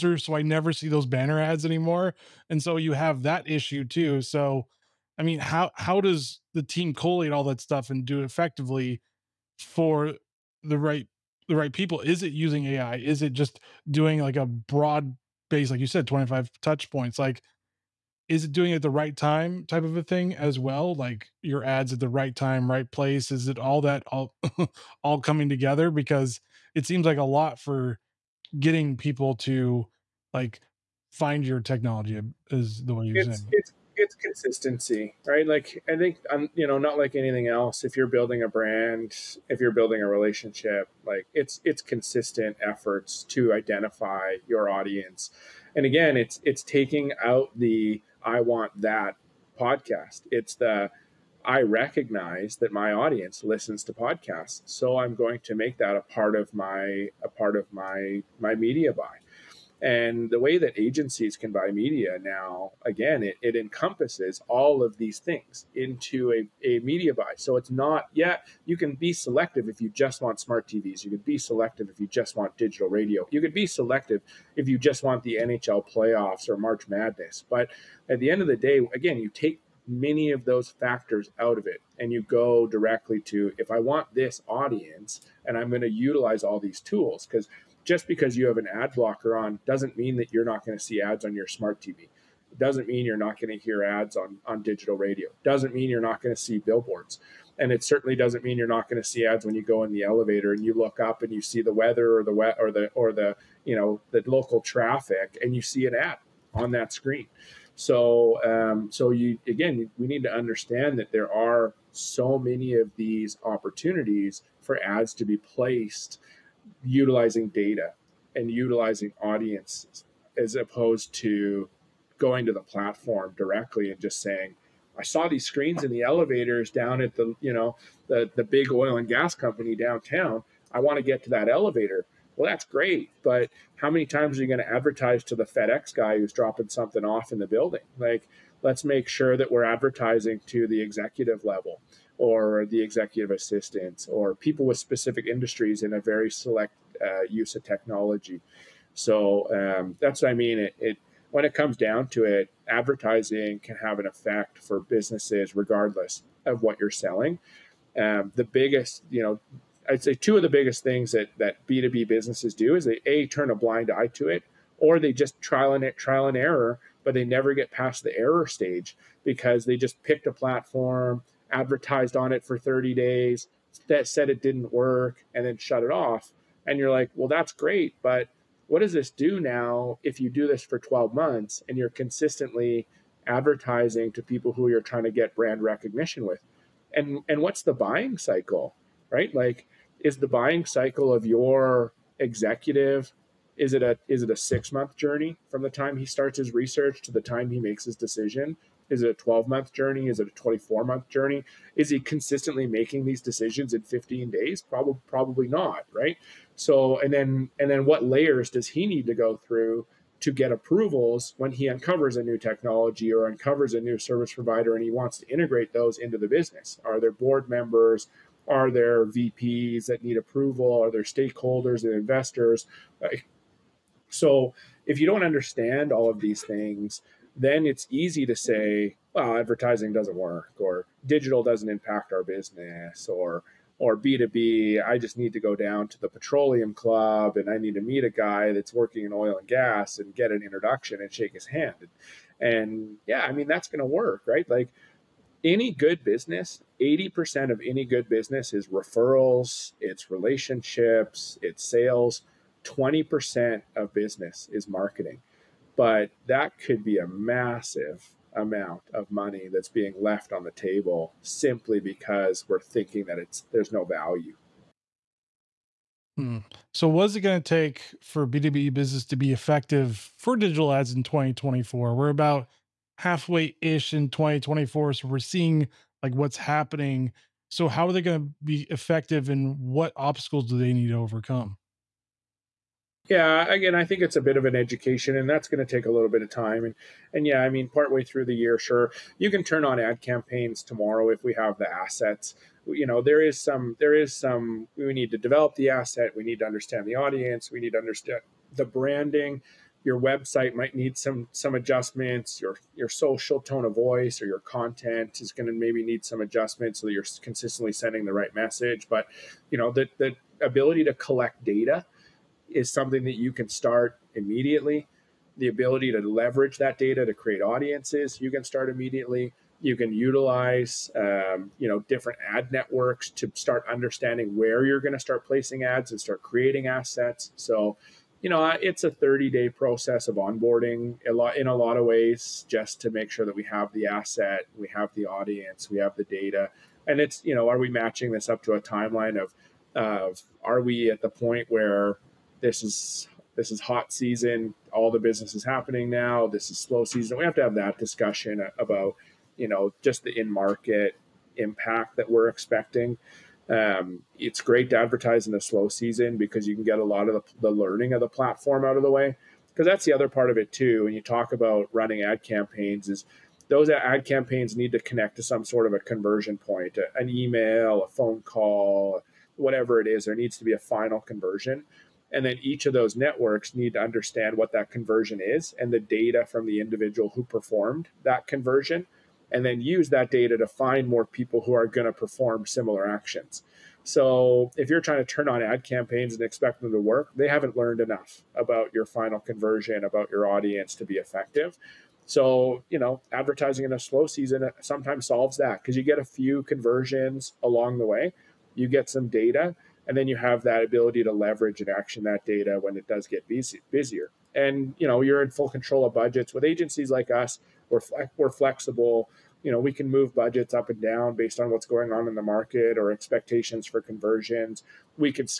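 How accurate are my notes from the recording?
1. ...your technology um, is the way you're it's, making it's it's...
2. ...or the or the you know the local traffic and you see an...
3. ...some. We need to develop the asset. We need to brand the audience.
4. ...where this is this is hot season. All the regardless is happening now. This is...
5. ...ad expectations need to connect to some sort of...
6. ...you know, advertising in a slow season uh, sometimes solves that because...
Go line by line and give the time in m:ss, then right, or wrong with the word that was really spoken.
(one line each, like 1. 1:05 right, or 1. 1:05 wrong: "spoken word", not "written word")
1. 0:31 wrong: "saying", not "making"
2. 1:42 right
3. 4:54 wrong: "understand", not "brand"
4. 5:41 wrong: "business", not "regardless"
5. 6:03 wrong: "campaigns", not "expectations"
6. 6:32 right.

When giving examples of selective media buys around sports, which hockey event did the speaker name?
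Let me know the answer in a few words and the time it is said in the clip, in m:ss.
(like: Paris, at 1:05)
NHL playoffs, at 1:15.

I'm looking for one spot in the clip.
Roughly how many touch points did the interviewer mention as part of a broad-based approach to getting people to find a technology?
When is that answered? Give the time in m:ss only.
0:16.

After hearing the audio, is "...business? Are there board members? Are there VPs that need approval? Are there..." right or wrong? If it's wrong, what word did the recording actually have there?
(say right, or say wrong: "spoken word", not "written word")
right.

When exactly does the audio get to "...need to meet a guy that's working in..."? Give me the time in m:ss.
3:57.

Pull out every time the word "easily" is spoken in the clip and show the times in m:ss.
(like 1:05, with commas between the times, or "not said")
not said.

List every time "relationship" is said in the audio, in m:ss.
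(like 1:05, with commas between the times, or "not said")
0:40, 4:10.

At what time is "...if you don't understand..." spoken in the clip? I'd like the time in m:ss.
3:44.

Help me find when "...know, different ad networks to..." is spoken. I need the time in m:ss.
5:21.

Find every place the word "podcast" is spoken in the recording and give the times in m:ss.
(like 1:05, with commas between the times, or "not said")
0:49, 0:53.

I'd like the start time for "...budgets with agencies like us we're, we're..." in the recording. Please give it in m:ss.
6:45.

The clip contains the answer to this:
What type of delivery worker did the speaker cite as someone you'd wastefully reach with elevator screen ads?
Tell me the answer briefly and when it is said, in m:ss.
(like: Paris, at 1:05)
FedEx guy, at 2:15.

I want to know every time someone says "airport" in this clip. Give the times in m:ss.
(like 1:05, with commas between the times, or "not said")
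not said.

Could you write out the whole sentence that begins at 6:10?
There needs to be a final conversion.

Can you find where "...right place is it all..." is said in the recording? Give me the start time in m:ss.
0:22.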